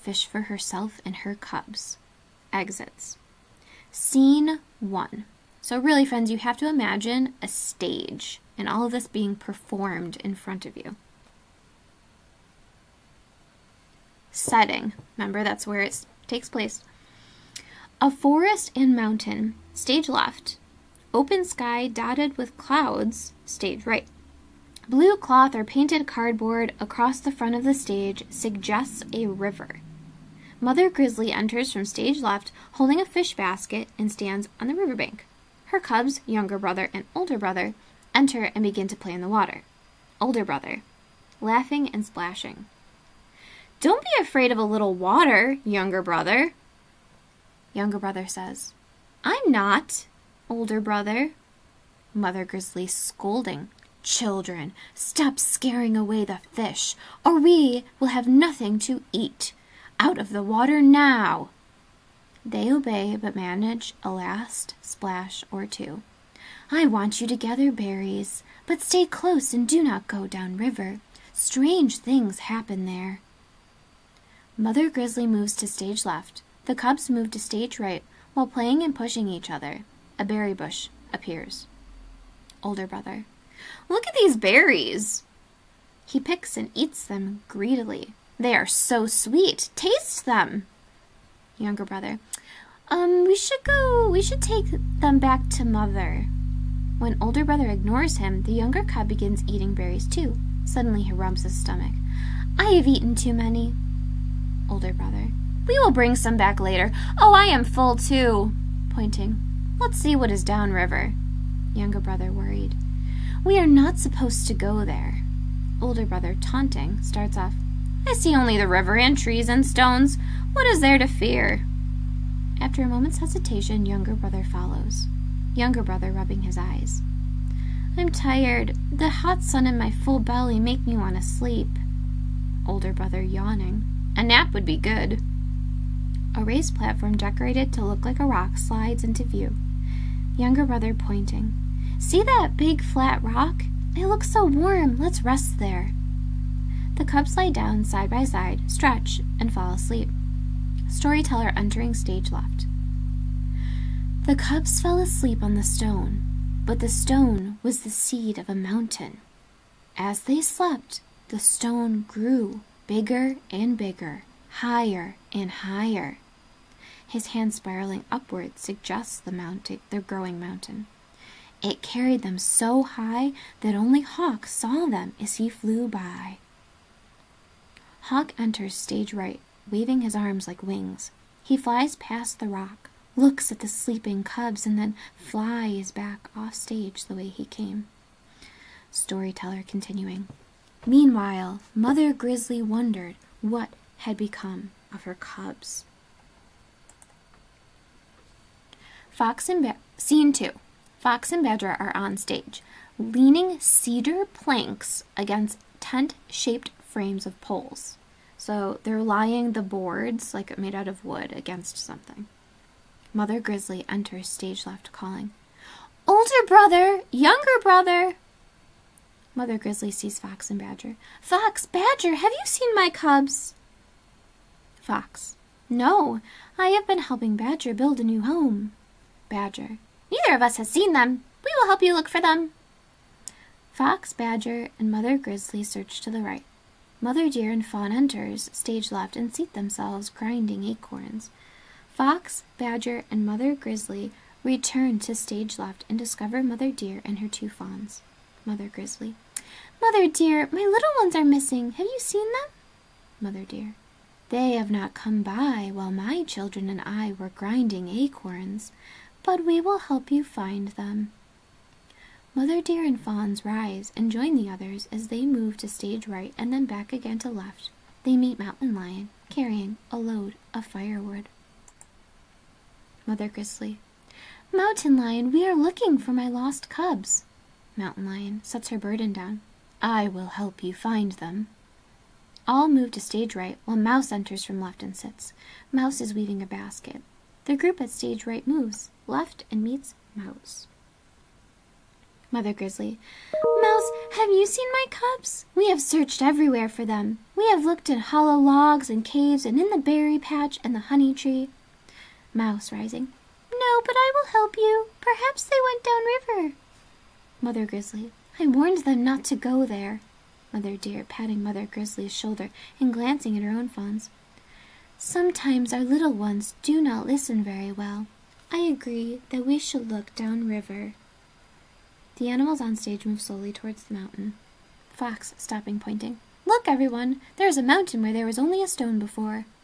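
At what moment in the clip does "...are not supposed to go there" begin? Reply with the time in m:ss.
1:53.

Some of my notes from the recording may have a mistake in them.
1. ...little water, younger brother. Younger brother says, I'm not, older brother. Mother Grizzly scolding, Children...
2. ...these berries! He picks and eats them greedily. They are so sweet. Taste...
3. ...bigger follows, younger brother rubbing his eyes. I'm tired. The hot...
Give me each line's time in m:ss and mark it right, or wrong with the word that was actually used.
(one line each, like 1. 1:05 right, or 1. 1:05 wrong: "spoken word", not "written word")
1. 0:44 right
2. 1:24 right
3. 2:04 wrong: "brother", not "bigger".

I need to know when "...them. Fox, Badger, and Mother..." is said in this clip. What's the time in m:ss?
3:52.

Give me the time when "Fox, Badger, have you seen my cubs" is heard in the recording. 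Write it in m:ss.
3:41.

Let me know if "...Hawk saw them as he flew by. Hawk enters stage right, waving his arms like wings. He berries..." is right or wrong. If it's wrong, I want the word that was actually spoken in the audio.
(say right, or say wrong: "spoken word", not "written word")
wrong: "flies", not "berries".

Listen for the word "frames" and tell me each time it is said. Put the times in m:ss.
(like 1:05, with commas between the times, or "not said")
3:26.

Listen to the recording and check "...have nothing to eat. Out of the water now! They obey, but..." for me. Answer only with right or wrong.
right.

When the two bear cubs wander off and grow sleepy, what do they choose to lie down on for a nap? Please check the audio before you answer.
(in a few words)
Big flat rock.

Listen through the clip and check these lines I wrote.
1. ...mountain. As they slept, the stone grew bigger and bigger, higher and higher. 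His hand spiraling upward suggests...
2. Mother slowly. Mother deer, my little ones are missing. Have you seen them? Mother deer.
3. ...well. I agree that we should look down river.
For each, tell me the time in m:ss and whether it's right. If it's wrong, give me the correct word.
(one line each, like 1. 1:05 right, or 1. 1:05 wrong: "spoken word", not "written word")
1. 2:38 right
2. 4:08 wrong: "grizzly", not "slowly"
3. 5:17 right.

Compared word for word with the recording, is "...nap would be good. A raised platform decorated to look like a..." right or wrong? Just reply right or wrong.
right.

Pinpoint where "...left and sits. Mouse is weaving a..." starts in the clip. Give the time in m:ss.
4:44.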